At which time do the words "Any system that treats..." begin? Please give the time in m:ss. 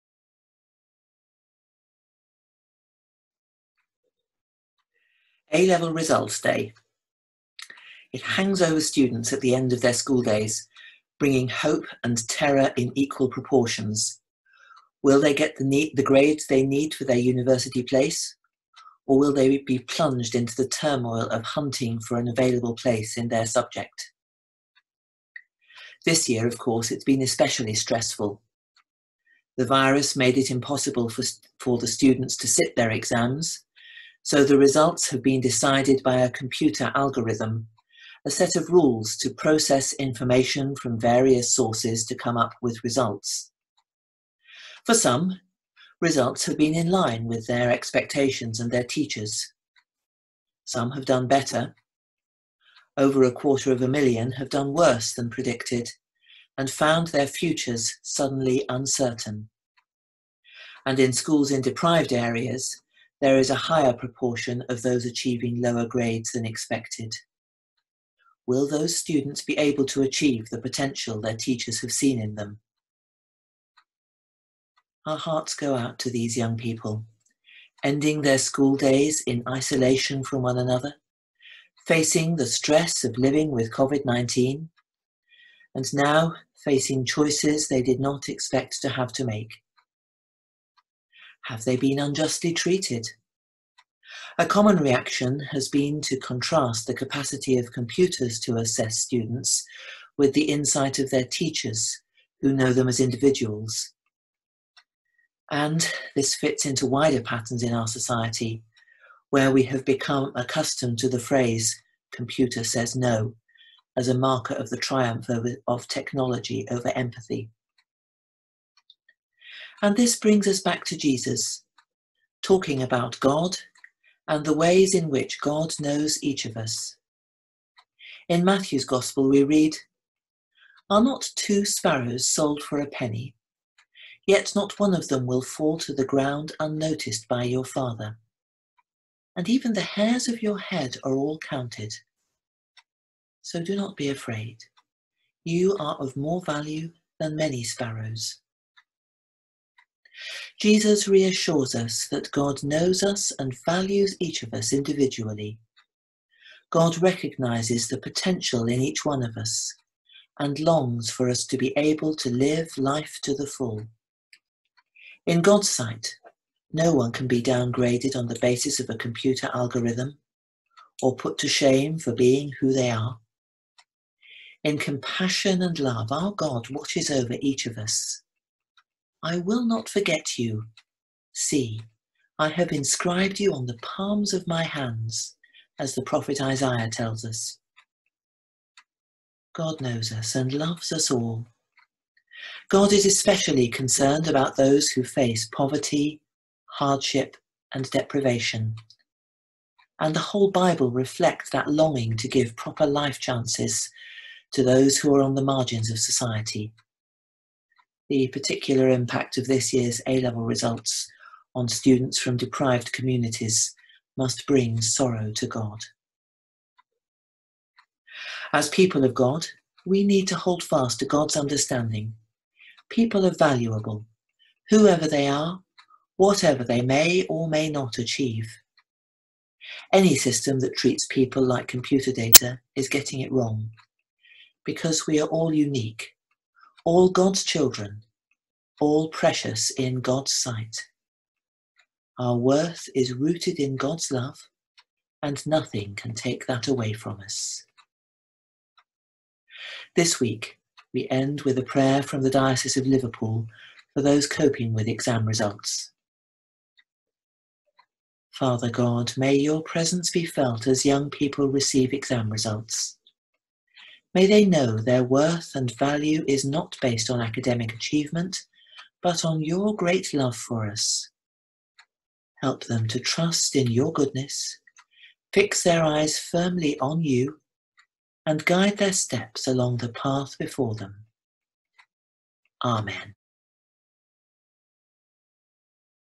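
3:49.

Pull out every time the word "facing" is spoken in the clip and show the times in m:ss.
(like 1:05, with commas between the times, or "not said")
1:21, 1:26.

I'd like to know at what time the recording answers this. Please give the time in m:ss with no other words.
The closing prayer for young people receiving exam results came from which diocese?
4:12.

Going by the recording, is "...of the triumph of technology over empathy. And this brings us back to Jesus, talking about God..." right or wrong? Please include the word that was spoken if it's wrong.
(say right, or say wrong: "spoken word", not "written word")
right.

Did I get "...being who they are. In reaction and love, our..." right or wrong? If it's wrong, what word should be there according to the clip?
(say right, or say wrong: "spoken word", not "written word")
wrong: "compassion", not "reaction".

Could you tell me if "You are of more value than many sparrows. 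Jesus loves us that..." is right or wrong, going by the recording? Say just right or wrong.
wrong.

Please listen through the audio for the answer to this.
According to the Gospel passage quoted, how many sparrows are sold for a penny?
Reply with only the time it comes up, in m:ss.
2:11.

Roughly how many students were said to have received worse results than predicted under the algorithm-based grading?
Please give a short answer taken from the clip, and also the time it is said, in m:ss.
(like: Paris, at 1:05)
Over 250,000, at 0:52.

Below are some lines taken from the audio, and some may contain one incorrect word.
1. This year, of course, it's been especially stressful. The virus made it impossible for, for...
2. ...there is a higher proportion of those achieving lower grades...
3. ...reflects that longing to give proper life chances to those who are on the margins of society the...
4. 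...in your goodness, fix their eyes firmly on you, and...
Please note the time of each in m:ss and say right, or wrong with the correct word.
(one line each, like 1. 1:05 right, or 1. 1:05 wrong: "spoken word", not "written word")
1. 0:26 right
2. 1:03 right
3. 3:20 right
4. 4:33 right.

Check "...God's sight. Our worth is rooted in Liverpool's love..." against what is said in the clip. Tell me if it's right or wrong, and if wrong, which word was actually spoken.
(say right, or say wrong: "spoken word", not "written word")
wrong: "God", not "Liverpool".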